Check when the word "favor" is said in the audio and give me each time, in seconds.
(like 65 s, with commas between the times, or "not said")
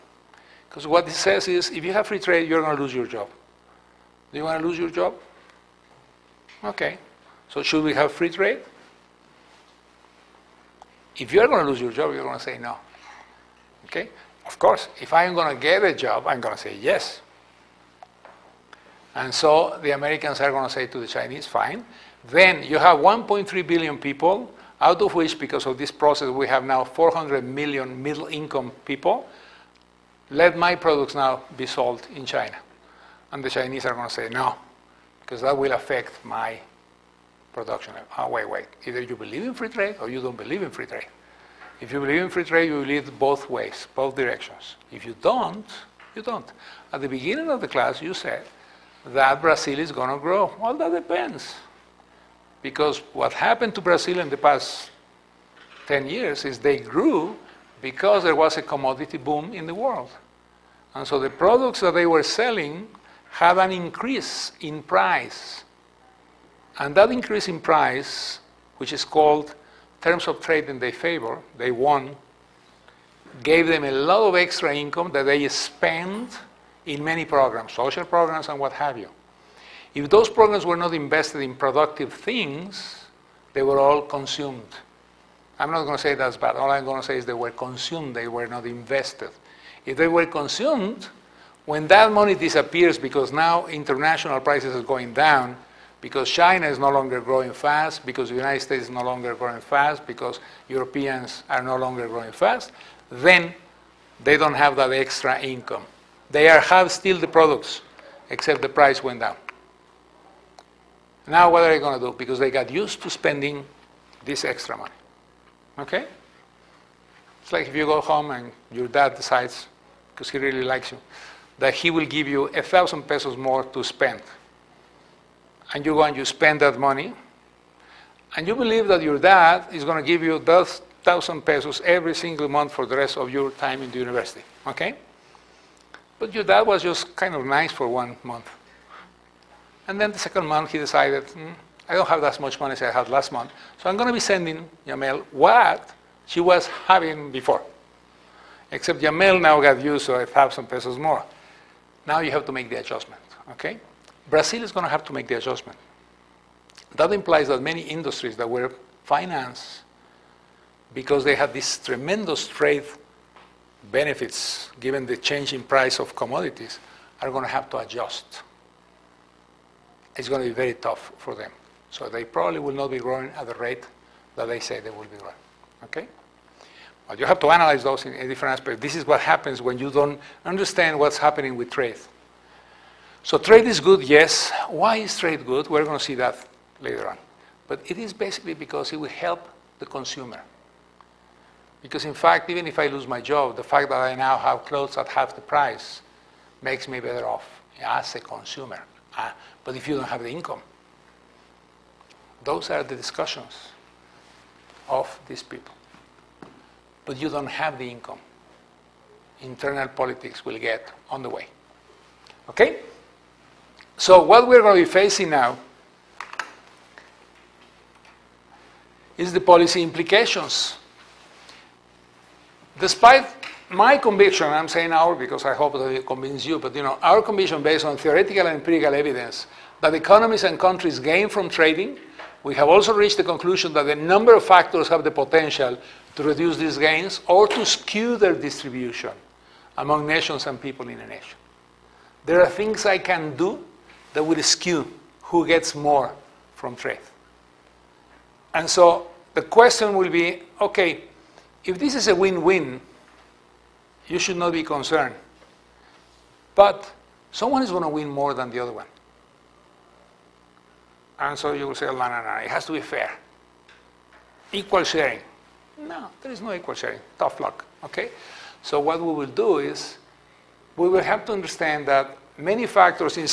70 s.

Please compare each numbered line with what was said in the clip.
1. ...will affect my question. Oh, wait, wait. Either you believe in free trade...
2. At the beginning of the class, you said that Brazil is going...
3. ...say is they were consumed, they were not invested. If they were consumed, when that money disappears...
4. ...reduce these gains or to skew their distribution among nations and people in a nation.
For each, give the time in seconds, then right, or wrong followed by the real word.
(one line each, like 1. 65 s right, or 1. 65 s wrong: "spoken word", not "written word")
1. 35 s wrong: "production", not "question"
2. 46 s right
3. 87 s right
4. 236 s right.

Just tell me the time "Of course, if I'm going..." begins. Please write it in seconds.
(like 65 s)
14 s.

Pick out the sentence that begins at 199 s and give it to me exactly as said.
Uh, but if you don't have the income, those are the discussions of these people.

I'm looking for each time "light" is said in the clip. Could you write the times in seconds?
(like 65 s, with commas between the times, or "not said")
not said.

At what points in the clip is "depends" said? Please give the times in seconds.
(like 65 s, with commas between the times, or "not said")
50 s.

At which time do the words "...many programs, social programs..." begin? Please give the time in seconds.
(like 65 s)
77 s.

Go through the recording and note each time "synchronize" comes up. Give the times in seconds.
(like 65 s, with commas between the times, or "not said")
not said.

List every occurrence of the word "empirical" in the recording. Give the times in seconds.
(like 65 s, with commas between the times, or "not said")
228 s.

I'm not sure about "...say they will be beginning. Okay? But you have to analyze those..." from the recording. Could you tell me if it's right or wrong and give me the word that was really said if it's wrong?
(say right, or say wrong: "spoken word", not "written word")
wrong: "growing", not "beginning".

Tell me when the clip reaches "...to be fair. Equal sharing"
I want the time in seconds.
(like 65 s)
262 s.